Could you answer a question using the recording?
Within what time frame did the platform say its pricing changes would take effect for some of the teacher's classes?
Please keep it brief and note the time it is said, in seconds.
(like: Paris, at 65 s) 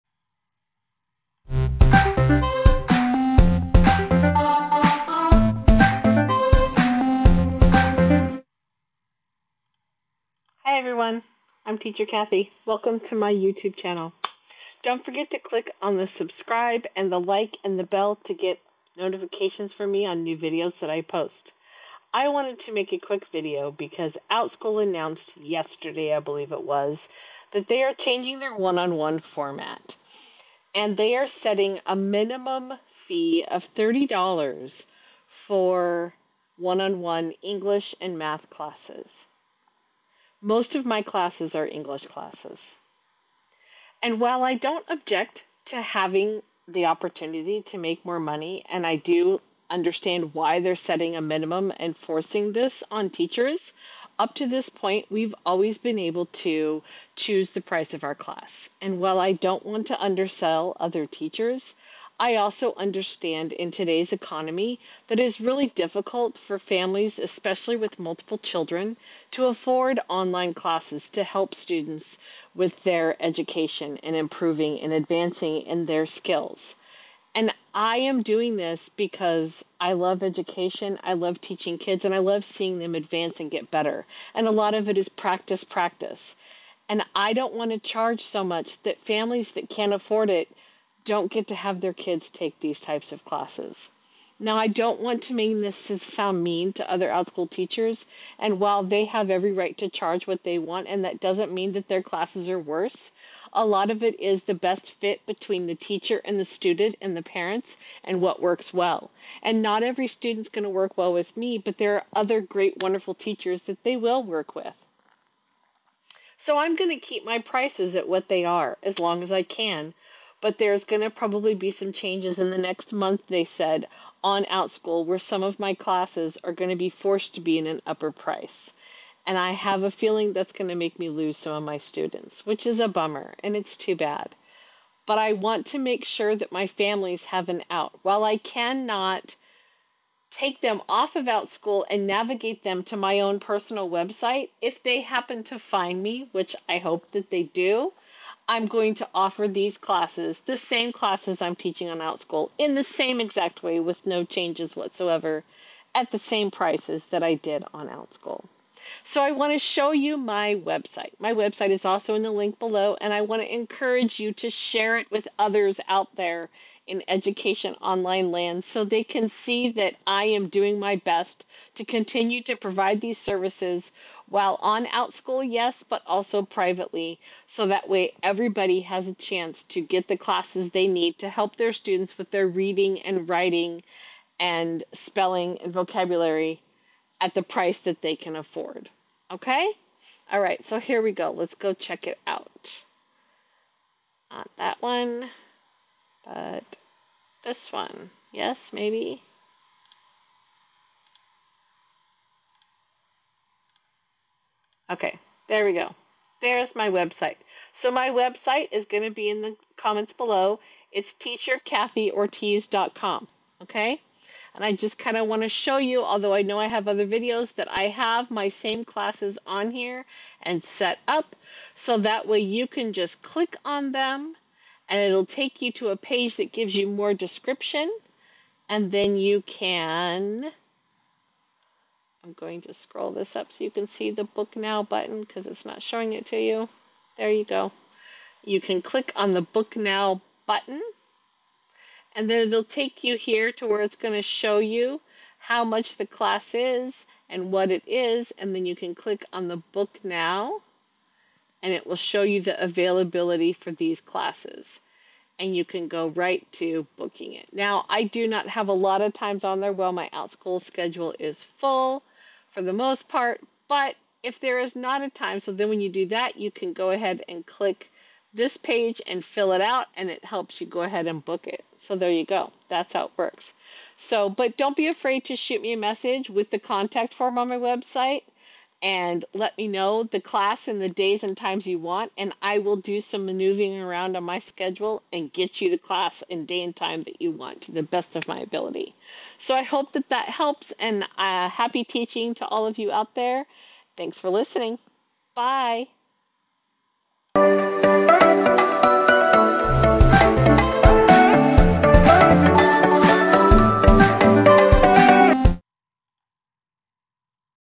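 the next month, at 122 s.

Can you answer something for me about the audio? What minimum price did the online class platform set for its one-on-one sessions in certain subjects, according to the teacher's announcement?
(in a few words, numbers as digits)
$30.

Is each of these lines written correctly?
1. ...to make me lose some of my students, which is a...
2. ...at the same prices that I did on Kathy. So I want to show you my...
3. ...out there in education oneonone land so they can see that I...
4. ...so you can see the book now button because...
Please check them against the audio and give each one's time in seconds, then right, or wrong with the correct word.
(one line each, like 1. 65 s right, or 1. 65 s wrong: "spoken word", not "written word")
1. 130 s right
2. 155 s wrong: "OutSchool", not "Kathy"
3. 165 s wrong: "online", not "oneonone"
4. 233 s right.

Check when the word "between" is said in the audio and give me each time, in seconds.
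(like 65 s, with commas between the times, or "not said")
105 s.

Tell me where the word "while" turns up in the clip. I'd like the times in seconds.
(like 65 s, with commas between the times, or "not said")
44 s, 58 s, 98 s, 138 s, 174 s.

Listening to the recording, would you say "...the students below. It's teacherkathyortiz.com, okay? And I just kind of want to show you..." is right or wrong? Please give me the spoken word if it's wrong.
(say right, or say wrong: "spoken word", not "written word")
wrong: "comments", not "students".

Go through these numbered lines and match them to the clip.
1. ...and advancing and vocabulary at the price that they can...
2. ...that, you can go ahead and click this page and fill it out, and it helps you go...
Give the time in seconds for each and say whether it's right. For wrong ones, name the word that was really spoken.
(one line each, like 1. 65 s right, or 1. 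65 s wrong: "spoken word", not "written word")
1. 184 s wrong: "spelling", not "advancing"
2. 266 s right.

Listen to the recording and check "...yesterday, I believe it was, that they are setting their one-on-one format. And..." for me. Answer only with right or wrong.
wrong.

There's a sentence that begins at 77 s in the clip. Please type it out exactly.
And I am doing this because I love education, I love teaching kids, and I love seeing them advance and get better.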